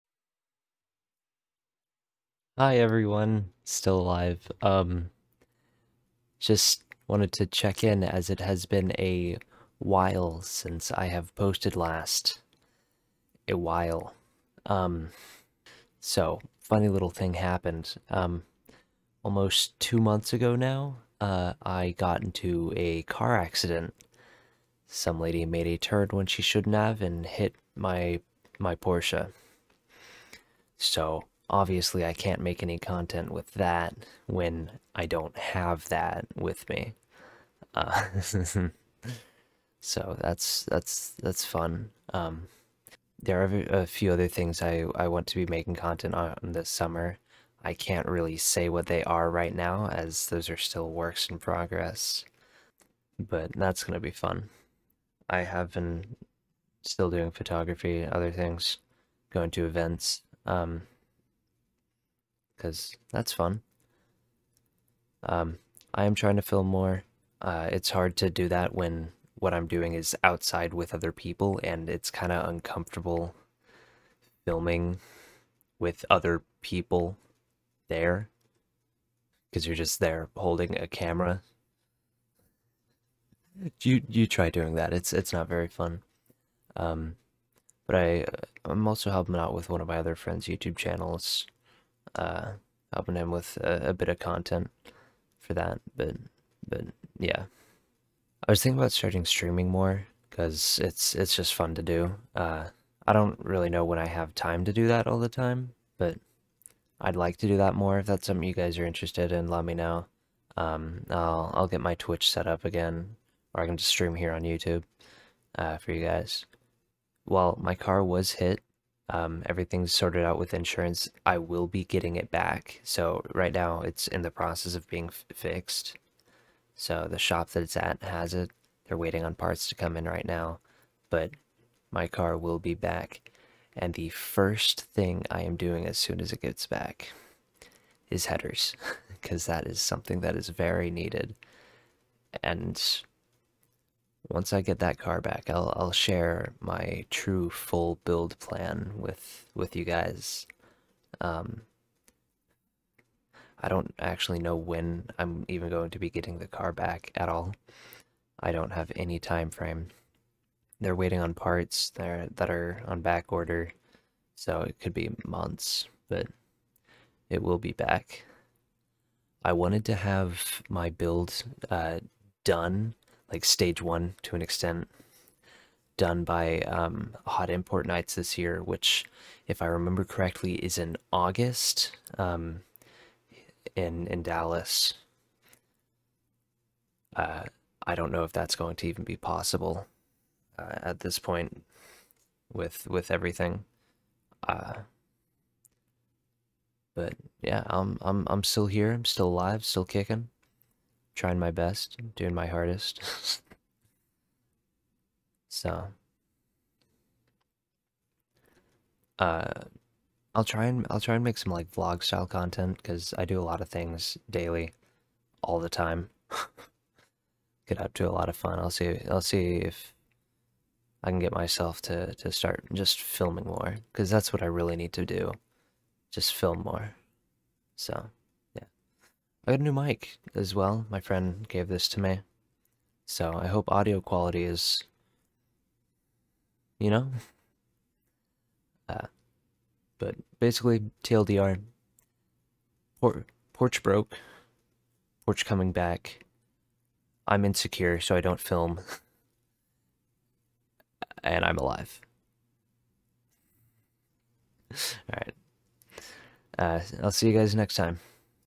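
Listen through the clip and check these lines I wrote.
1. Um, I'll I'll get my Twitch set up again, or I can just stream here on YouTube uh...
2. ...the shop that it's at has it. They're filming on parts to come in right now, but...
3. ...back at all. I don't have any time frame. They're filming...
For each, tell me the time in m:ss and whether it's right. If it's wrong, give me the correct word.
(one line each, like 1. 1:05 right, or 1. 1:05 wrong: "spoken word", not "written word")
1. 1:50 right
2. 2:07 wrong: "waiting", not "filming"
3. 2:36 wrong: "waiting", not "filming".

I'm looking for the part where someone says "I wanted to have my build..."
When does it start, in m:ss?
2:49.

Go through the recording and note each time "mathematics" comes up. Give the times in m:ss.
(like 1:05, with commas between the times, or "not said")
not said.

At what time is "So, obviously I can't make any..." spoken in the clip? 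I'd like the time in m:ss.
0:30.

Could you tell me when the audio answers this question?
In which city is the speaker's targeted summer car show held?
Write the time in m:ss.
3:04.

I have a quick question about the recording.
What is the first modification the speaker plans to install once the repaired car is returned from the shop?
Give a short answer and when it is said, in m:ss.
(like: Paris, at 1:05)
Headers, at 2:18.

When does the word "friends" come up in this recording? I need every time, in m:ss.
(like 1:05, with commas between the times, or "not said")
1:30, 3:50.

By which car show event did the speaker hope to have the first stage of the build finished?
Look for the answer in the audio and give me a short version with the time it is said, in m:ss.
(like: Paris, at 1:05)
Hot Import Nights, at 2:57.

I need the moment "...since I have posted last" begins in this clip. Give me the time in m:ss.
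0:10.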